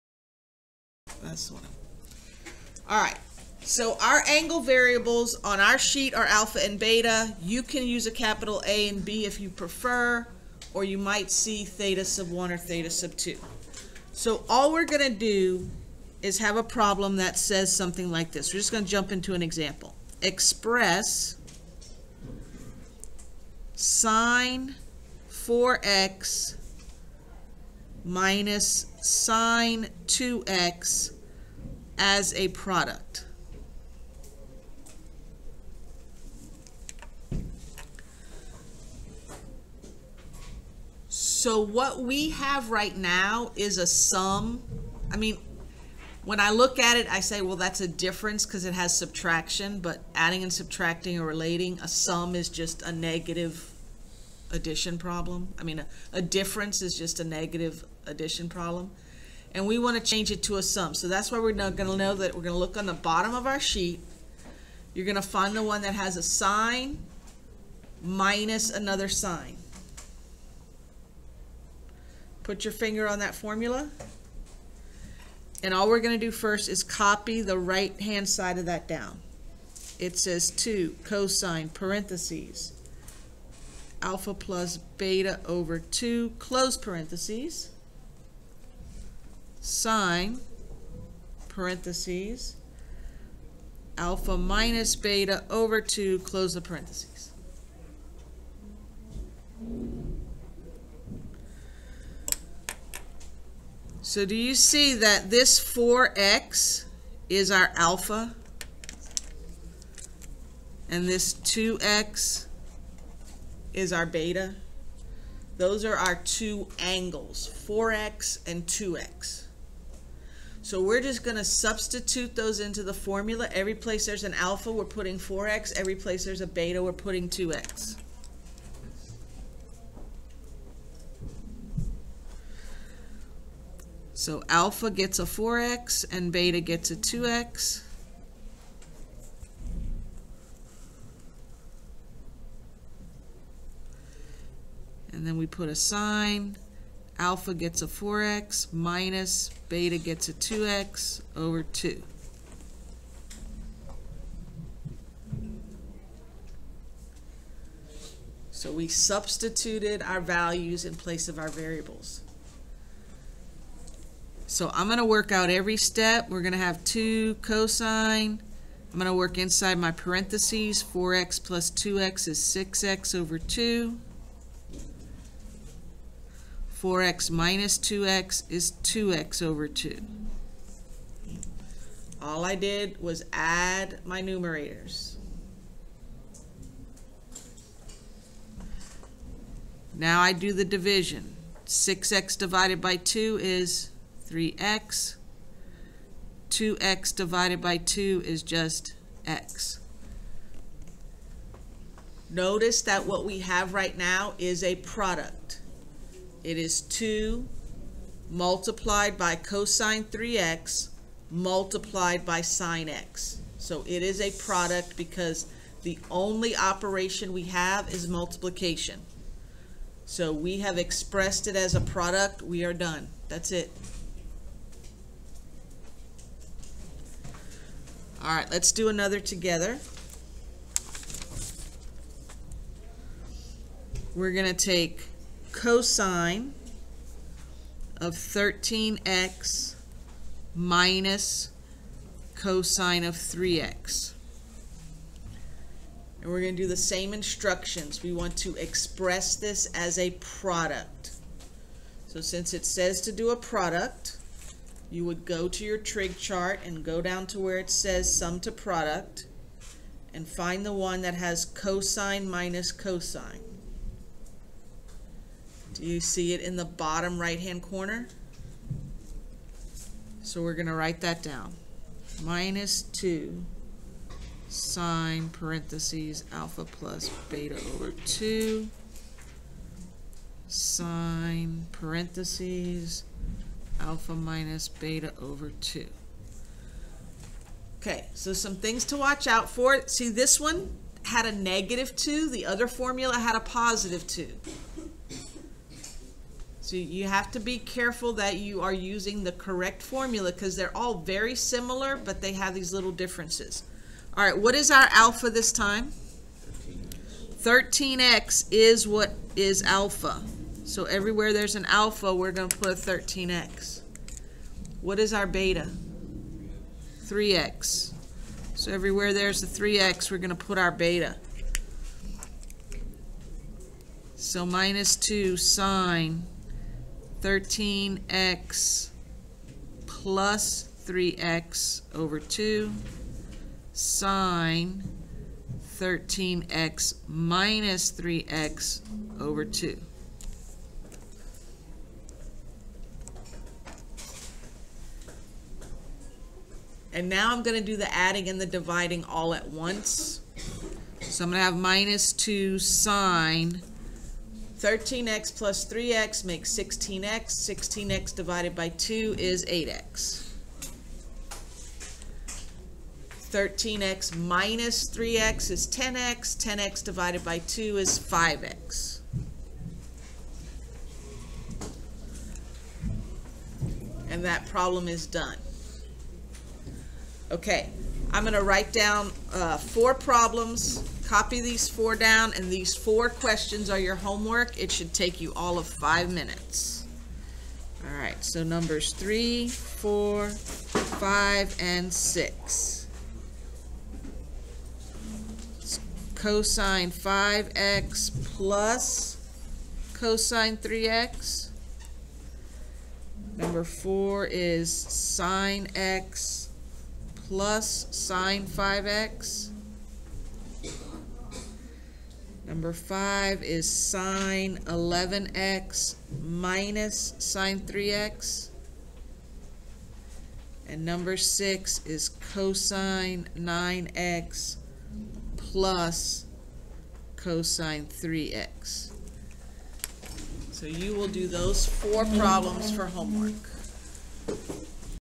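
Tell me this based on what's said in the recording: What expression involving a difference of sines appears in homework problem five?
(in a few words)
sin 11x - sin 3x.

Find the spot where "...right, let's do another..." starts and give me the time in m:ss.
3:48.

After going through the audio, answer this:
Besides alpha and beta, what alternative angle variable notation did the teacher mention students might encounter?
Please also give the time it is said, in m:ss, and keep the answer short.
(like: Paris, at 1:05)
theta sub 1, at 0:11.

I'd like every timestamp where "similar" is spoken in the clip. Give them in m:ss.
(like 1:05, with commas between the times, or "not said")
5:01.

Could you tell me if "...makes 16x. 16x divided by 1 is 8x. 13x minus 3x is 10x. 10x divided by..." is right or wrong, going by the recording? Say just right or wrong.
wrong.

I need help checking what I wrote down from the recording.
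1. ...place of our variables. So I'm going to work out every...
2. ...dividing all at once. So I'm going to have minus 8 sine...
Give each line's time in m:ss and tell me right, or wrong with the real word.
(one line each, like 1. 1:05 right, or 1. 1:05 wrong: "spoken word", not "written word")
1. 2:40 right
2. 5:48 wrong: "2", not "8".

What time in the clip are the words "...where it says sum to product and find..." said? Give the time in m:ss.
4:17.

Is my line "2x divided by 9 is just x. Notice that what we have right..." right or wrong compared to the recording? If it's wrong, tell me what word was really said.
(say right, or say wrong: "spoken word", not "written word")
wrong: "2", not "9".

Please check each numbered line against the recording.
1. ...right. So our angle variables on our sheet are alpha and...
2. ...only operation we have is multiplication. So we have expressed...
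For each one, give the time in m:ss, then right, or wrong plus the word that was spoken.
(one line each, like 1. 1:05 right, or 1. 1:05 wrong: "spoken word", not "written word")
1. 0:03 right
2. 3:36 right.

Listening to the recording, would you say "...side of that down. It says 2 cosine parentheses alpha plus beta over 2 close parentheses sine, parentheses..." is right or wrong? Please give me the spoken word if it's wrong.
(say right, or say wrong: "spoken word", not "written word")
right.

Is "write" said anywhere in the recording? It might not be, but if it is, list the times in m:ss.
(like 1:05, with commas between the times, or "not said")
4:30, 6:18.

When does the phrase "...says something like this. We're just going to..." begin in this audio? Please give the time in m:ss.
0:17.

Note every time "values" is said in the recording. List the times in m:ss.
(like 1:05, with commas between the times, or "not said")
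2:40.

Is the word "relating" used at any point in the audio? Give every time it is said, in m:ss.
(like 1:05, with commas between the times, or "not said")
0:51.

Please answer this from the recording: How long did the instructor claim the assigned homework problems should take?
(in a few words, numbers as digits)
5 minutes.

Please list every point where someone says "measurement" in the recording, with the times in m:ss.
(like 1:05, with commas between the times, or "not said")
not said.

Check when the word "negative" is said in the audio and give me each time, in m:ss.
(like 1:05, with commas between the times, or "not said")
0:52, 0:57, 4:51.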